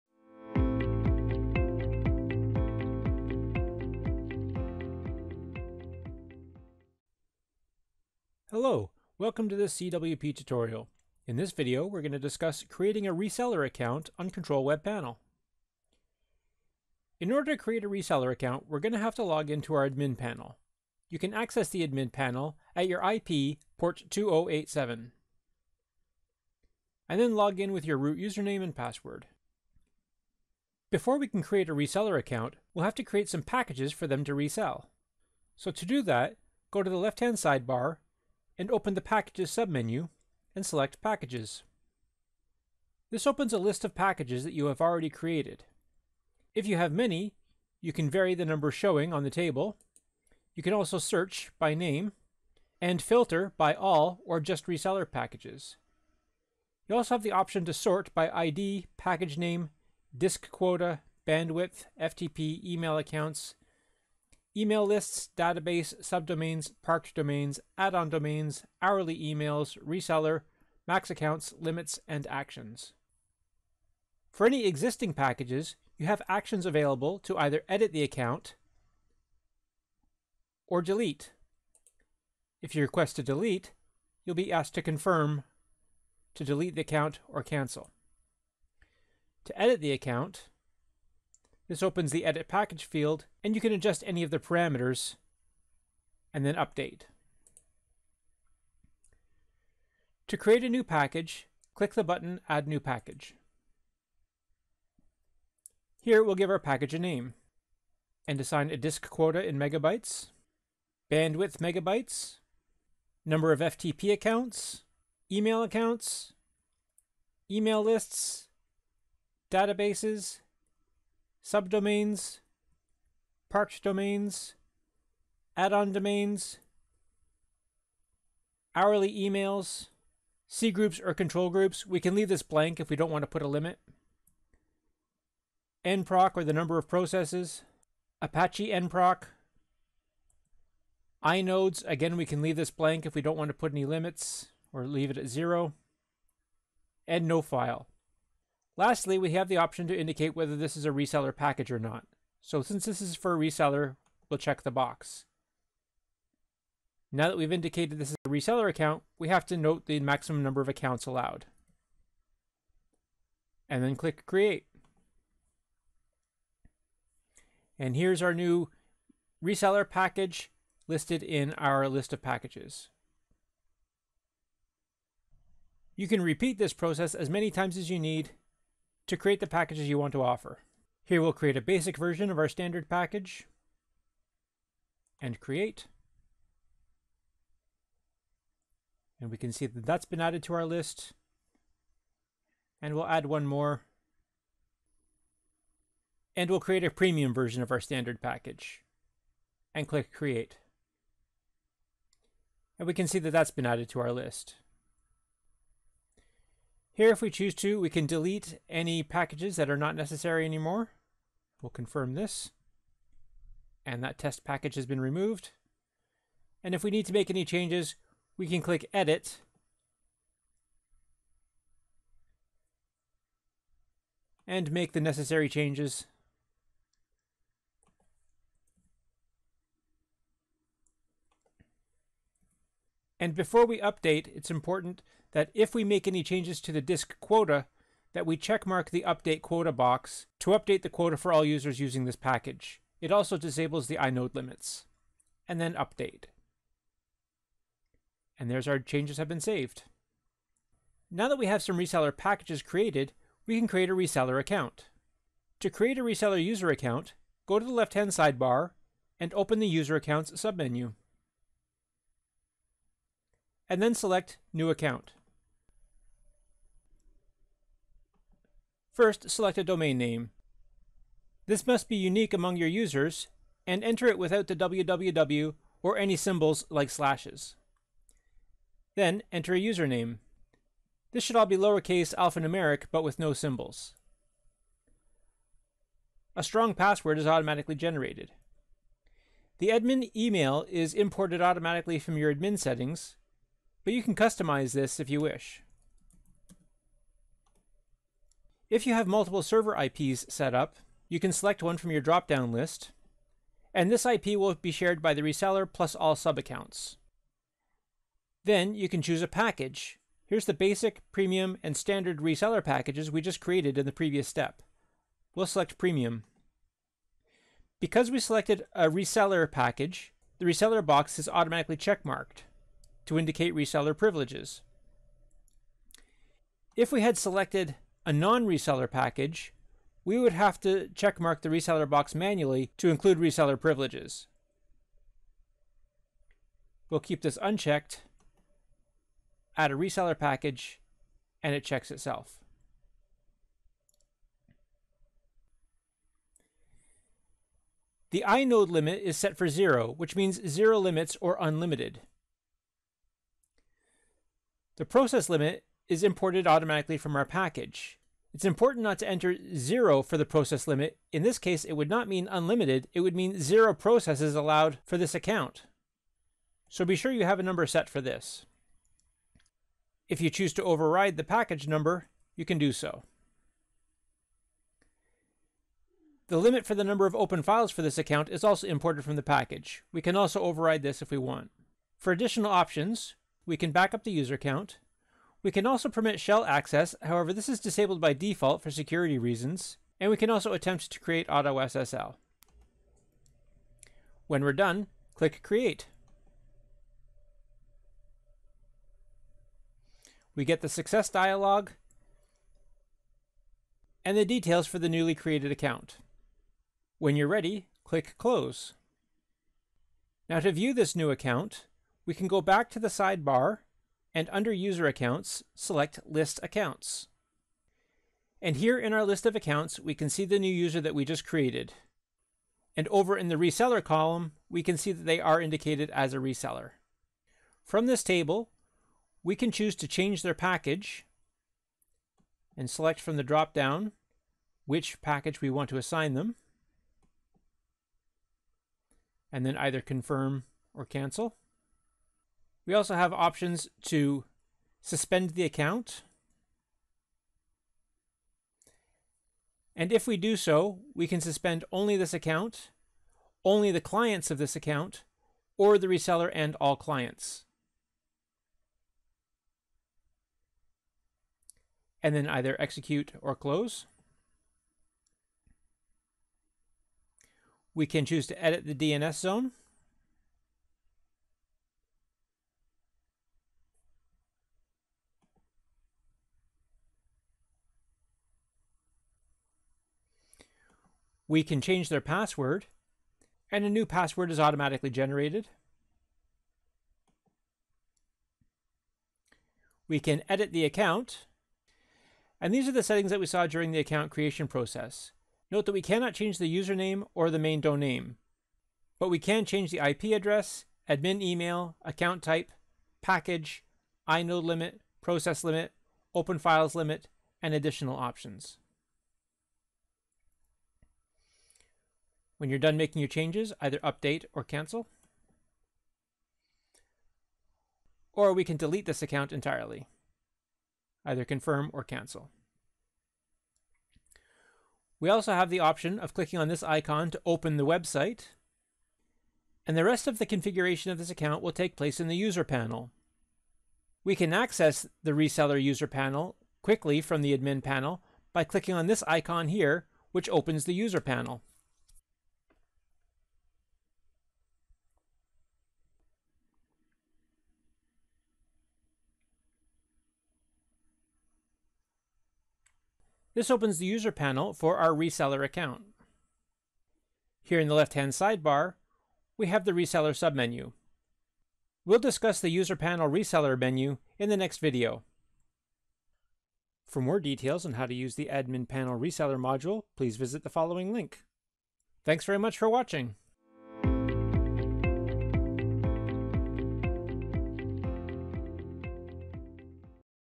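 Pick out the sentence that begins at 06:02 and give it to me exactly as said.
It would mean zero processes allowed for this account.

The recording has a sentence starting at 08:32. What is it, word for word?
When you're done making your changes, either update or cancel.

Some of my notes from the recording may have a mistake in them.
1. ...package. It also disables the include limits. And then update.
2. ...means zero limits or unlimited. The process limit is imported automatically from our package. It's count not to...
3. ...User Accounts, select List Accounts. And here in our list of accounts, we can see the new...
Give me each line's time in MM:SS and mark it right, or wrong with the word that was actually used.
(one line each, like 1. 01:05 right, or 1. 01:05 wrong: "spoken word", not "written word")
1. 04:02 wrong: "inode", not "include"
2. 05:50 wrong: "important", not "count"
3. 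06:54 right.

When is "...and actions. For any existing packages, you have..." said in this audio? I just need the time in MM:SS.
01:12.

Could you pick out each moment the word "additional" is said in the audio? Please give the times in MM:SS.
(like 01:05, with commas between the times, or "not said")
06:22, 08:27.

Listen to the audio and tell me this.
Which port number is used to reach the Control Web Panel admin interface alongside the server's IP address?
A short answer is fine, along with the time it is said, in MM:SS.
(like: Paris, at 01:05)
2087, at 00:24.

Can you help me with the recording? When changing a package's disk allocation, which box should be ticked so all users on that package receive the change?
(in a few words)
update quota.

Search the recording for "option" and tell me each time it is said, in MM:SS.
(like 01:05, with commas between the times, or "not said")
00:57, 02:29, 06:22, 07:23, 08:27, 08:45.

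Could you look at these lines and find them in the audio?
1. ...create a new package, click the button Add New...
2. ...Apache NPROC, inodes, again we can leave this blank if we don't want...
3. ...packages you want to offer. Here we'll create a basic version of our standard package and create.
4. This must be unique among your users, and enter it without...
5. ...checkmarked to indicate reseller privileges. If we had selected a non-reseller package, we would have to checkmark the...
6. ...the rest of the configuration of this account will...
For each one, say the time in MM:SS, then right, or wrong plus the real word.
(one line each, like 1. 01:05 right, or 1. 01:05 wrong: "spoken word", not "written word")
1. 01:40 right
2. 02:18 right
3. 02:59 right
4. 04:31 right
5. 05:21 right
6. 08:49 right.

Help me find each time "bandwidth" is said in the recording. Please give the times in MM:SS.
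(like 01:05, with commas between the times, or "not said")
01:01, 01:51.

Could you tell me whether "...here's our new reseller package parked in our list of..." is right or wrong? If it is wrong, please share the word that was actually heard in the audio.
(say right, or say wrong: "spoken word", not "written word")
wrong: "listed", not "parked".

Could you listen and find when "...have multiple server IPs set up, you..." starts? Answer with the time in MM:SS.
04:58.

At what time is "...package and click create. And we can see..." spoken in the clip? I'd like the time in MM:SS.
03:18.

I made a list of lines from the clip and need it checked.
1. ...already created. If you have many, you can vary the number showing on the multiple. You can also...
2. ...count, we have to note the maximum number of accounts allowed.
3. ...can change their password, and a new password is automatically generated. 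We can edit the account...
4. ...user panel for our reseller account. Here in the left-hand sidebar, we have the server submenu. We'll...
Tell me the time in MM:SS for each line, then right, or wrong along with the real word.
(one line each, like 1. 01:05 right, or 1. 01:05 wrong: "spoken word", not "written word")
1. 00:44 wrong: "table", not "multiple"
2. 02:38 wrong: "account", not "count"
3. 08:01 right
4. 09:13 wrong: "reseller", not "server".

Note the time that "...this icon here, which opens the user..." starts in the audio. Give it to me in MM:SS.
08:58.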